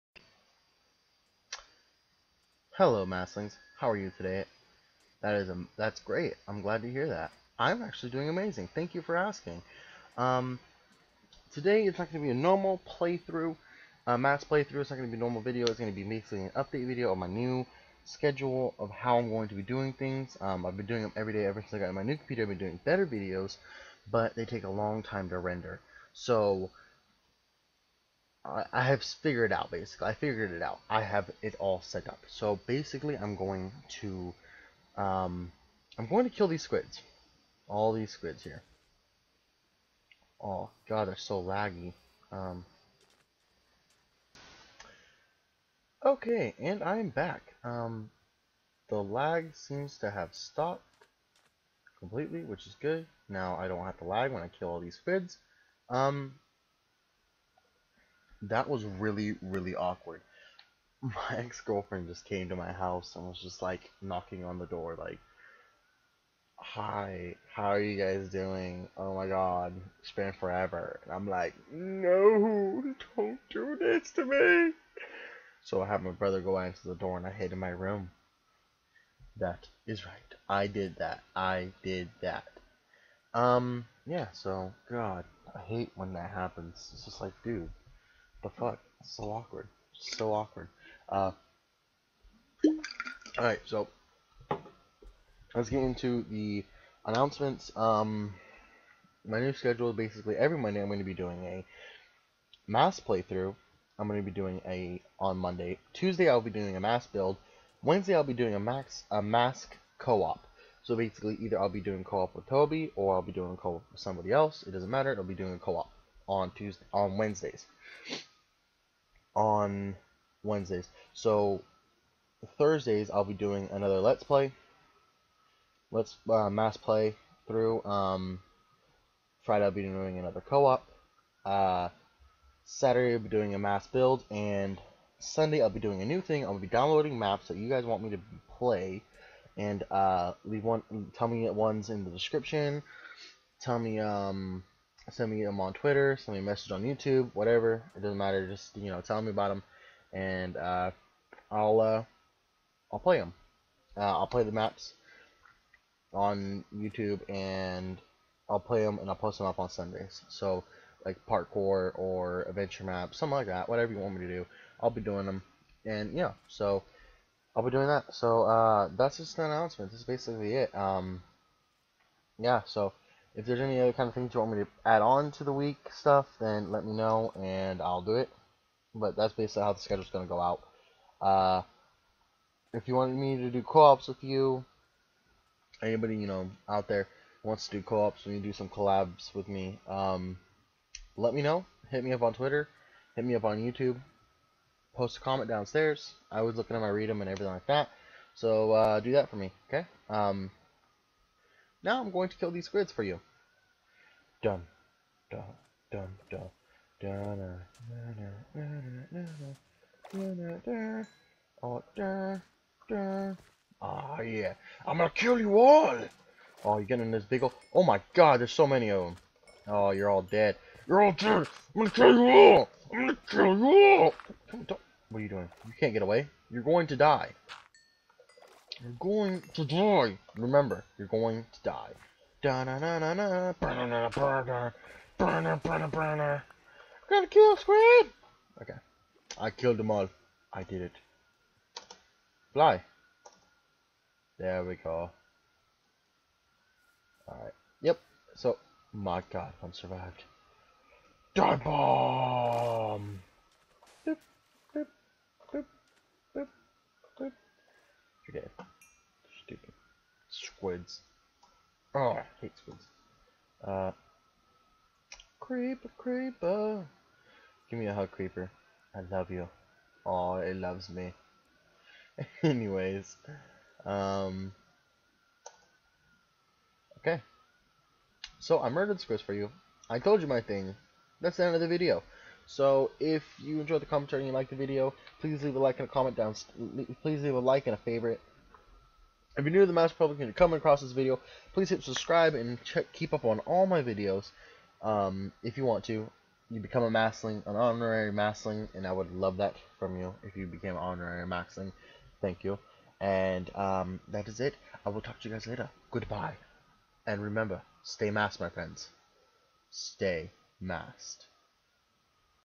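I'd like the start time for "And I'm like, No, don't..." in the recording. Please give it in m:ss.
1:11.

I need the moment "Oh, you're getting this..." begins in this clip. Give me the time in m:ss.
3:36.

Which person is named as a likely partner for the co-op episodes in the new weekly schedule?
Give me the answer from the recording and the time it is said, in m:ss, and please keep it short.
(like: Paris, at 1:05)
Toby, at 1:52.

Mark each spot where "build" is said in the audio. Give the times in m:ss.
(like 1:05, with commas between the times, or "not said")
1:47, 2:13.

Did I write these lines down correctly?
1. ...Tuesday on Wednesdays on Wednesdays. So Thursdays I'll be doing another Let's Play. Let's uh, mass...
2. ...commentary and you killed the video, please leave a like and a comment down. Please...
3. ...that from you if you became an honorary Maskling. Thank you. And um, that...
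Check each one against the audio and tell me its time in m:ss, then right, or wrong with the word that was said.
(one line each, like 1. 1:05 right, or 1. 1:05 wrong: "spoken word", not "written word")
1. 1:56 right
2. 4:43 wrong: "liked", not "killed"
3. 4:59 right.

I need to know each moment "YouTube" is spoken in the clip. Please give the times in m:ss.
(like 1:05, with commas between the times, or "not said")
2:26, 2:36, 3:13.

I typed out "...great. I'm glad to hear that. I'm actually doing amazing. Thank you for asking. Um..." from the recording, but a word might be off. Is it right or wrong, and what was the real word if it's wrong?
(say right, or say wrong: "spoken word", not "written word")
right.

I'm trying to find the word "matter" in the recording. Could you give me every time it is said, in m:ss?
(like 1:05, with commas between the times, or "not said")
1:54, 2:28.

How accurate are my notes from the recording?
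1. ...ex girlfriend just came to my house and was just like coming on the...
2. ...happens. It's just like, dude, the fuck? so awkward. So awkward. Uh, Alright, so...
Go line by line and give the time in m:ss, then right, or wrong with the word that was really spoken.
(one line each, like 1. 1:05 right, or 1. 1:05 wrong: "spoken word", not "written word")
1. 1:01 wrong: "knocking", not "coming"
2. 1:26 right.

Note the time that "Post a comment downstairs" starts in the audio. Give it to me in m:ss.
3:14.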